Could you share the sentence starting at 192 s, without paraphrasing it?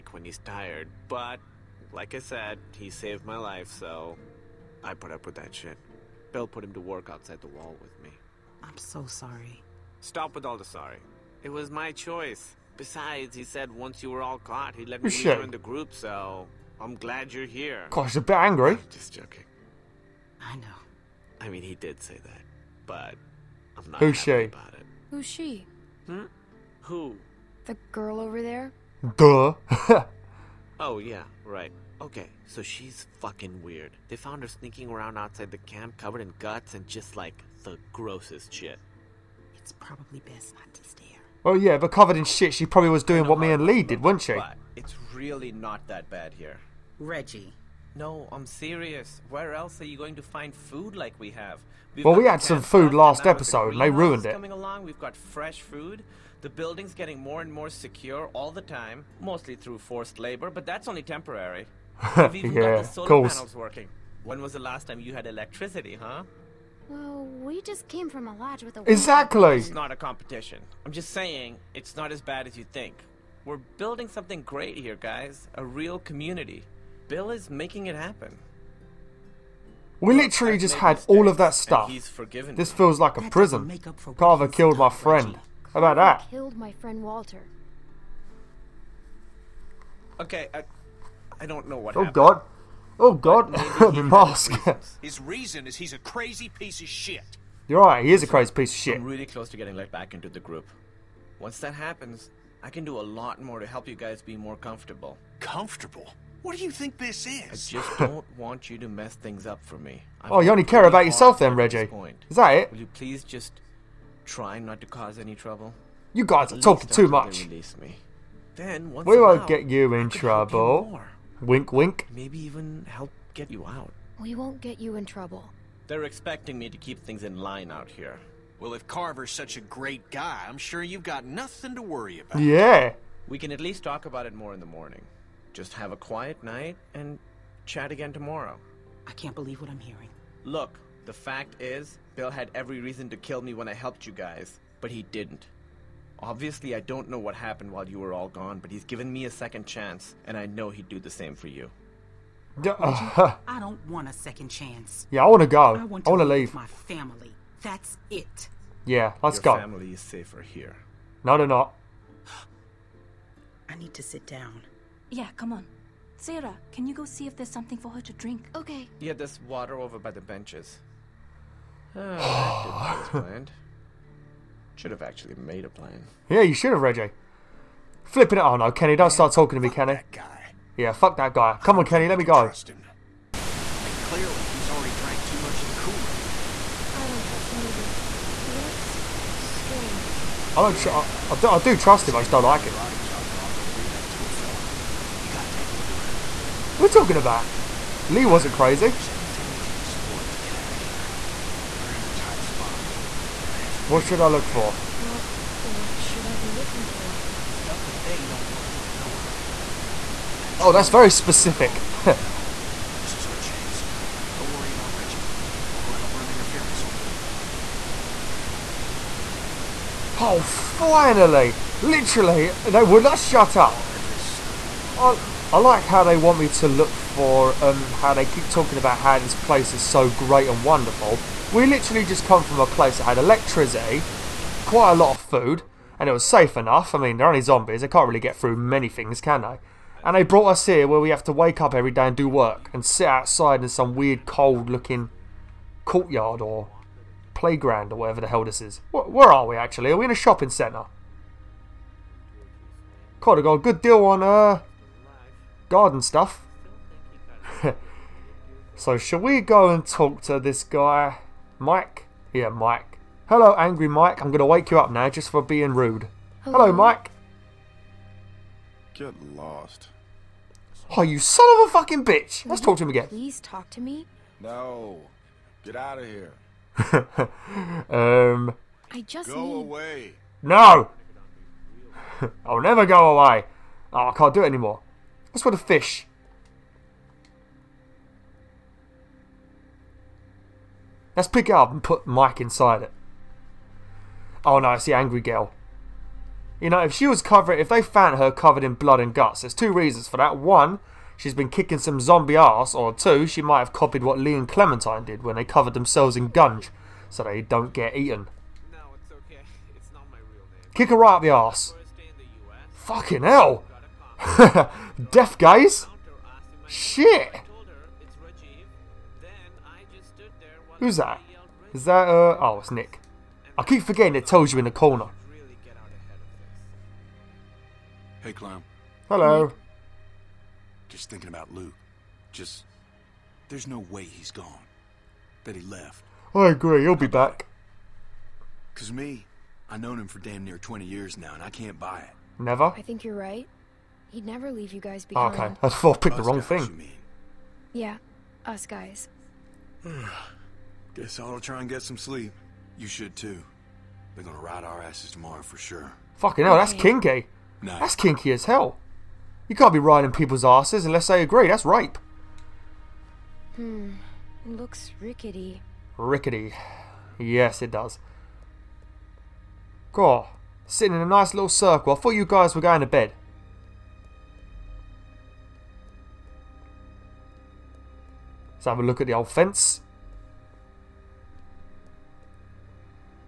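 Body chopped off can do that to a fella.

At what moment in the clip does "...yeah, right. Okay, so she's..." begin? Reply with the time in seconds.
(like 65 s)
30 s.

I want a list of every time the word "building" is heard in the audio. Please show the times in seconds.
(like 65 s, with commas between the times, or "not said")
56 s, 73 s.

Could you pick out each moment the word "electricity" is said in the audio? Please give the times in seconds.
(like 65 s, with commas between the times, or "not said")
65 s, 233 s.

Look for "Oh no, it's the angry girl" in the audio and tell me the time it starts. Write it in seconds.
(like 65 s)
294 s.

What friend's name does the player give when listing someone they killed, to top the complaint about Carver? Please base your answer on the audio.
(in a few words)
Walter.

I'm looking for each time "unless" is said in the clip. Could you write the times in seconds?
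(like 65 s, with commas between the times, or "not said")
360 s.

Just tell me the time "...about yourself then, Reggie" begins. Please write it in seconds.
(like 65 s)
110 s.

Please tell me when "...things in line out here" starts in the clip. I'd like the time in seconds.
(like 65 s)
126 s.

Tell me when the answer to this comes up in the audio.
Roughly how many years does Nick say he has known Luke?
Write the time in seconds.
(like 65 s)
340 s.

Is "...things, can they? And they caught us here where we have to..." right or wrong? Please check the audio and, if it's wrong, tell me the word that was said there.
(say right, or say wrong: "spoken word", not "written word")
wrong: "brought", not "caught".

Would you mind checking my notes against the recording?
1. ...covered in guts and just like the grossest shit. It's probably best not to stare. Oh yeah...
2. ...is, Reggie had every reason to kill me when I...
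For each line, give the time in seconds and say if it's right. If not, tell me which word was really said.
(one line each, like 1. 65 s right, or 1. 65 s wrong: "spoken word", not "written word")
1. 35 s right
2. 141 s wrong: "Bill", not "Reggie".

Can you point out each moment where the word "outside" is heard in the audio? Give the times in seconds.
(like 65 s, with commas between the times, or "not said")
7 s, 35 s, 243 s.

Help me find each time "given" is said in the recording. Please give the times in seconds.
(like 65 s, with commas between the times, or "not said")
148 s.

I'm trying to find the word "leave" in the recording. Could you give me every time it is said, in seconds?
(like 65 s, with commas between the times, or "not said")
156 s, 344 s.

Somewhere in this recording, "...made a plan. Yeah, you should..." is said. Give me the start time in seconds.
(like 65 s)
175 s.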